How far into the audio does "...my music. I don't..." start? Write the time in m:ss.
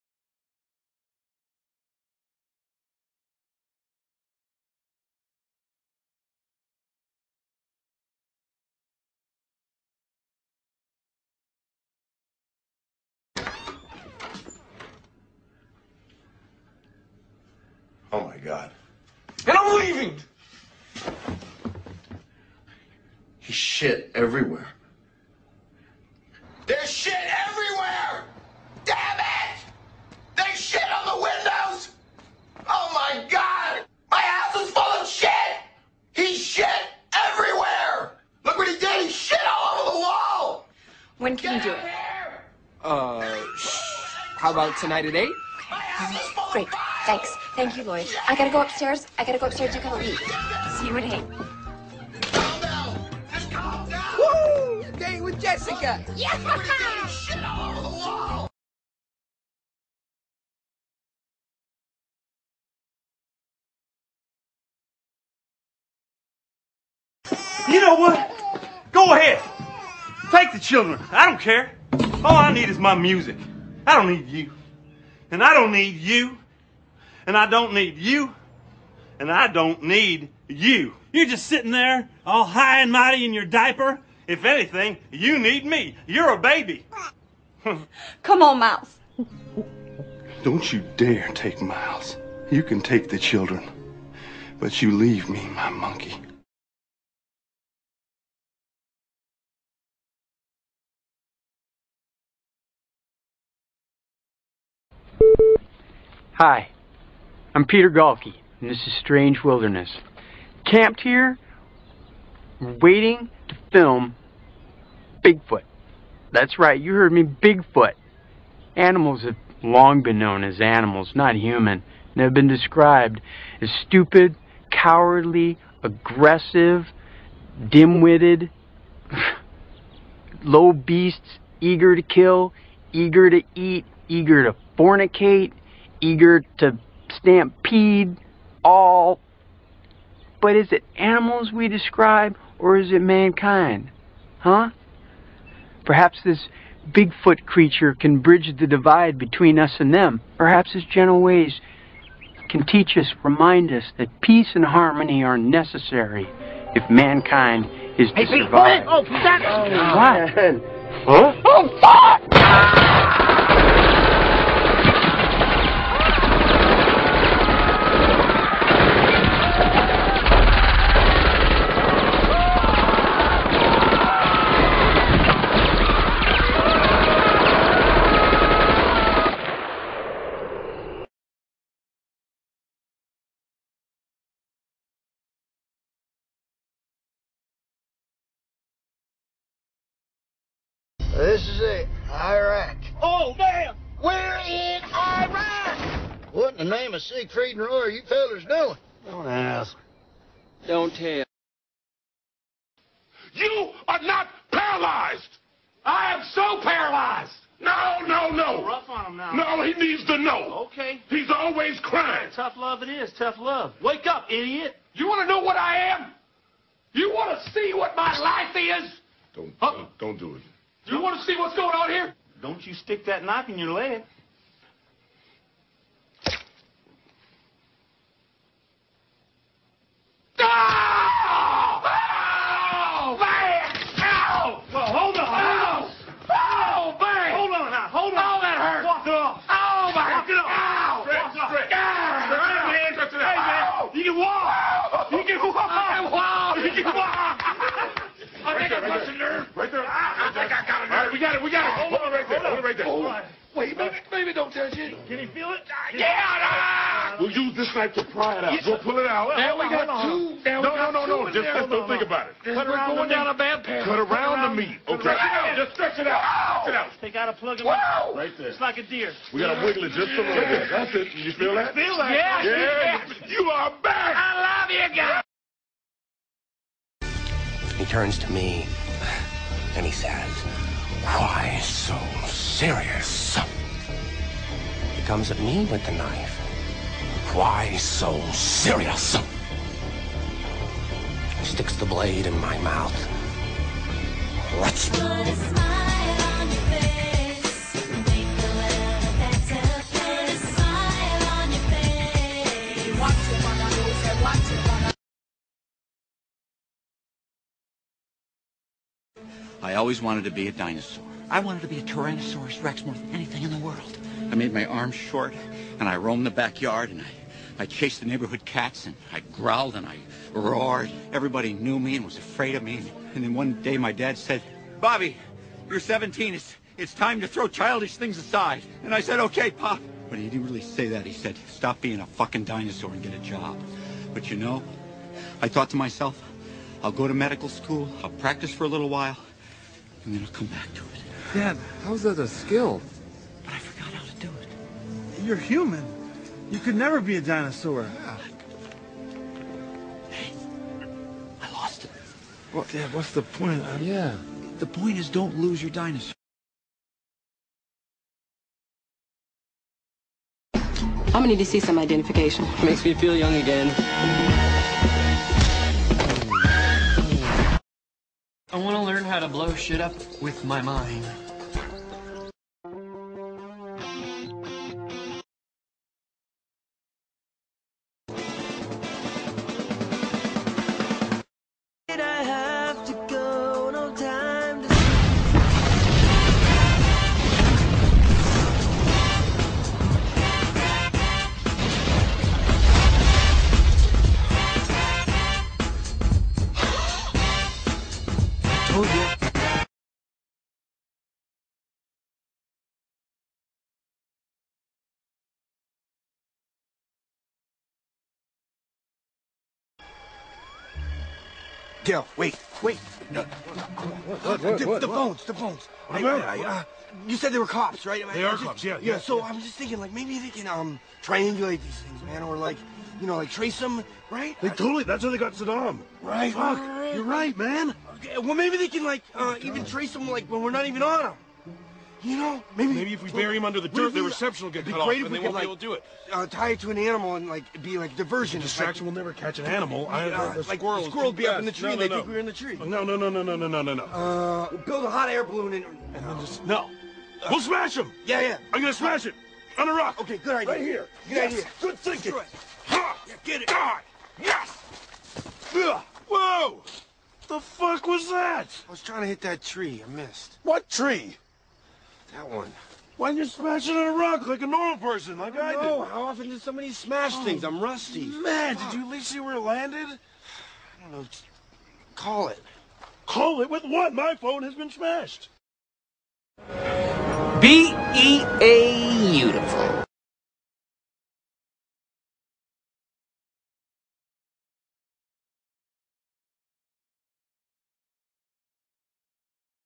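1:12.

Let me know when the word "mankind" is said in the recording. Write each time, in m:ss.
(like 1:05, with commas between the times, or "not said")
2:23, 2:36.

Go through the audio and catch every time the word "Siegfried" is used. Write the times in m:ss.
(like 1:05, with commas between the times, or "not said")
3:17.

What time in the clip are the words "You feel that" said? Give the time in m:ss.
4:31.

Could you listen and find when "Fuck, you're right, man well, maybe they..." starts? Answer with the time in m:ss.
7:06.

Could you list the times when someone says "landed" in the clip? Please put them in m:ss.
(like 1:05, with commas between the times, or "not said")
7:49.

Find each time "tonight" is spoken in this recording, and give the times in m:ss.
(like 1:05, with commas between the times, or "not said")
0:44.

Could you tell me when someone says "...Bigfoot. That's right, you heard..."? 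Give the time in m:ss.
1:55.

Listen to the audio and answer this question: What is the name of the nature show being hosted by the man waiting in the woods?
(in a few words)
Strange Wilderness.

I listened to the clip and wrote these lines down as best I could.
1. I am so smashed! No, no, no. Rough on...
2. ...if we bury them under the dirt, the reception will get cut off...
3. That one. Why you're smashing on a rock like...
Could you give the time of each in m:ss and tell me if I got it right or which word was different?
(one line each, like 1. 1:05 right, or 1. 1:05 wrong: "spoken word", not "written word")
1. 3:25 wrong: "paralyzed", not "smashed"
2. 7:12 right
3. 7:42 right.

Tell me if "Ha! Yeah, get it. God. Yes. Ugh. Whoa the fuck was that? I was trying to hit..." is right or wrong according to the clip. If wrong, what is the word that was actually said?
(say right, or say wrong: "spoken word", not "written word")
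right.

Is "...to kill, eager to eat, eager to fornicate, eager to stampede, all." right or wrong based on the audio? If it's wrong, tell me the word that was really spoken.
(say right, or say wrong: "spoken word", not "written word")
right.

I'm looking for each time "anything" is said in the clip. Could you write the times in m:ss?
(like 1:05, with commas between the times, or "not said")
1:24, 5:13.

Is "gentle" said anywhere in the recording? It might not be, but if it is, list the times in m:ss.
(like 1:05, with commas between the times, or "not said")
2:30.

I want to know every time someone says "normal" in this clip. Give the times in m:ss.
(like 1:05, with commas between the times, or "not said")
7:44.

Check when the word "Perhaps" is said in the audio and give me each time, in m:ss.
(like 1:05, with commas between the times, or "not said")
2:25, 2:30.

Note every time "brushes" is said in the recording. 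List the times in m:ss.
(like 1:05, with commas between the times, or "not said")
not said.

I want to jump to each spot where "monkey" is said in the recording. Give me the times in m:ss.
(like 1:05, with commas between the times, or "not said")
1:35.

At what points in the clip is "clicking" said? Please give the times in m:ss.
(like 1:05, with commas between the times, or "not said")
not said.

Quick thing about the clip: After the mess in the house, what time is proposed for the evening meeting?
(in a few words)
8.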